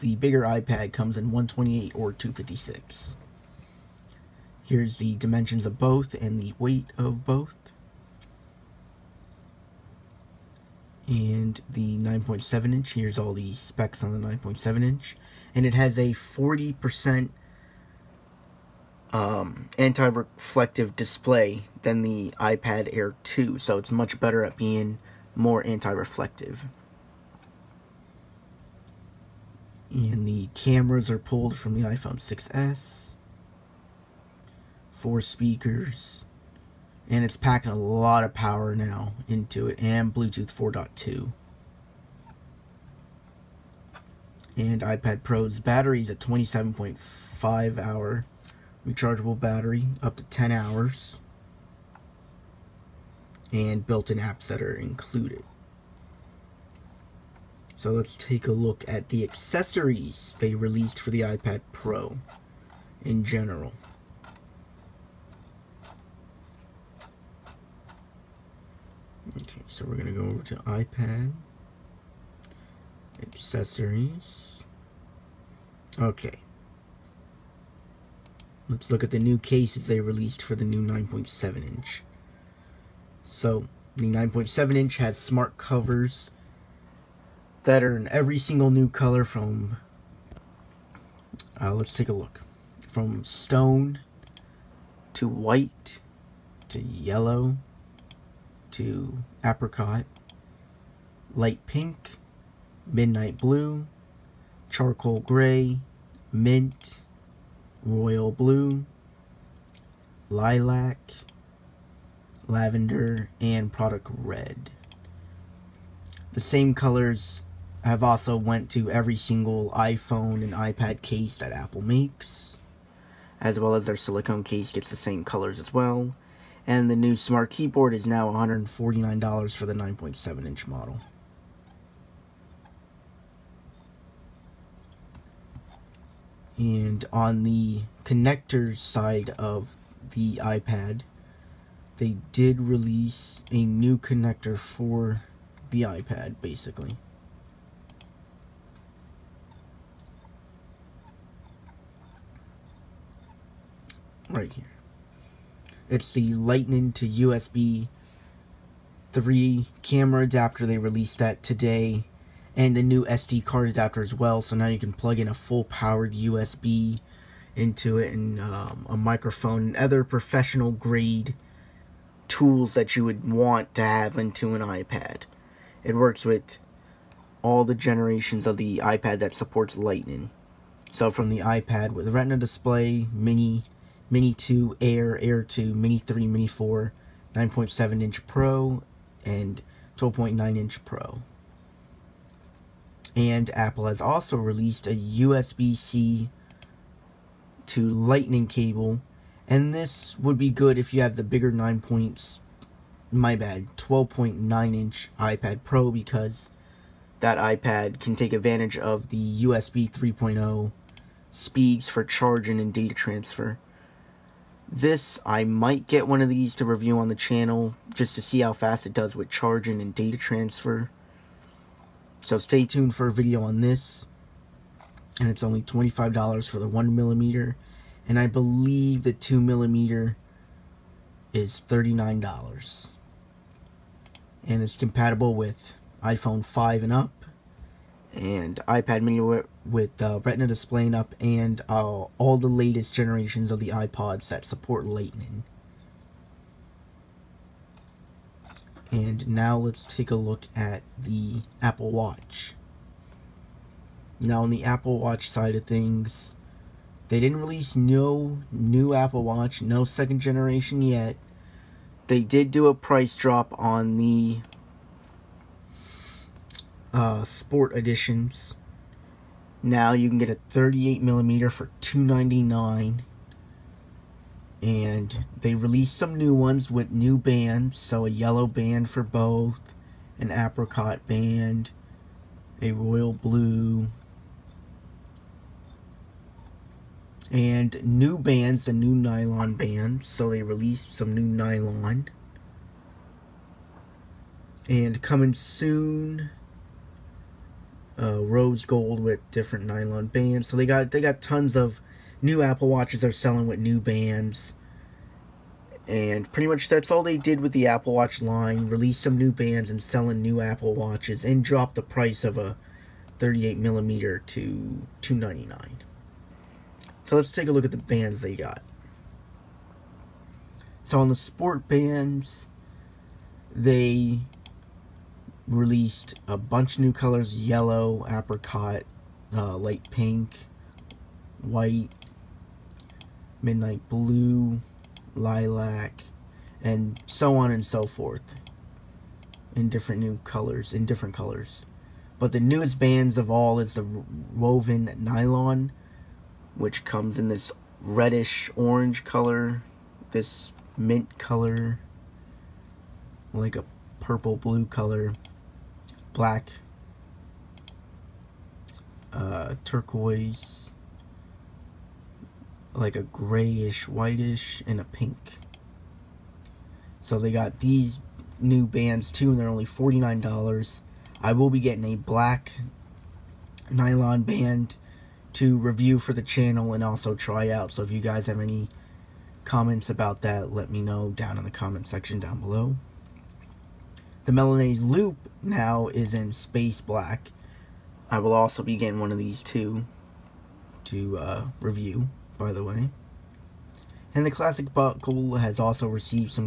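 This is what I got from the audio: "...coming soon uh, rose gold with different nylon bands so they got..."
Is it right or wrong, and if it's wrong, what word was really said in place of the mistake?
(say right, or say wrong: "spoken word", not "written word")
right.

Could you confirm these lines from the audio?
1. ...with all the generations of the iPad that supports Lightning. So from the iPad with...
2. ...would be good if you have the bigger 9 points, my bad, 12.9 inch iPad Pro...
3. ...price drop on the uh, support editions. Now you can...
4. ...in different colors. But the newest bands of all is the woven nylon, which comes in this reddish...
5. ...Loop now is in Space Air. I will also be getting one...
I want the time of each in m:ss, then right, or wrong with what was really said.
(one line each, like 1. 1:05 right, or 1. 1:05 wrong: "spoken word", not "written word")
1. 2:56 right
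2. 3:20 right
3. 4:22 wrong: "sport", not "support"
4. 5:40 right
5. 6:24 wrong: "Black", not "Air".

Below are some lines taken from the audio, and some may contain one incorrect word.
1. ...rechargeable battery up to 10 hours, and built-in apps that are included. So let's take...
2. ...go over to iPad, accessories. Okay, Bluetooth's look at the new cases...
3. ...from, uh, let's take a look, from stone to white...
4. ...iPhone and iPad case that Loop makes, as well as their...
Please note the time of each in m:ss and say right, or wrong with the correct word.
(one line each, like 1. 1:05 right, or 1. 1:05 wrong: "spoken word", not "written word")
1. 0:48 right
2. 1:10 wrong: "Let", not "Bluetooth"
3. 1:29 right
4. 1:59 wrong: "Apple", not "Loop".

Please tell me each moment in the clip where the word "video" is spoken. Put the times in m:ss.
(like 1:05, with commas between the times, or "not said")
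3:43.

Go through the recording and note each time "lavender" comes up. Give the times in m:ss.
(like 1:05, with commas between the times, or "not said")
1:52.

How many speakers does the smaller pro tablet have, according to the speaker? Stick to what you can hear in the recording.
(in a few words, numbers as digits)
4.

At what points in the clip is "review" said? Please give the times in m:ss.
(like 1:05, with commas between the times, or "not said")
3:36, 6:15, 6:31.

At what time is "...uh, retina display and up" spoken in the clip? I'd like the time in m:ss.
4:00.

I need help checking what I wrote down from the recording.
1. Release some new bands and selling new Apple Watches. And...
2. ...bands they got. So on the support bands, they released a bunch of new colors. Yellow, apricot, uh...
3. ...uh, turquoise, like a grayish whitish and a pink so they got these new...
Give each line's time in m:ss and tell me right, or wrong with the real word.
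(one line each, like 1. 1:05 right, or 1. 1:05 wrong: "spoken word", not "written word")
1. 5:08 right
2. 5:17 wrong: "sport", not "support"
3. 5:59 right.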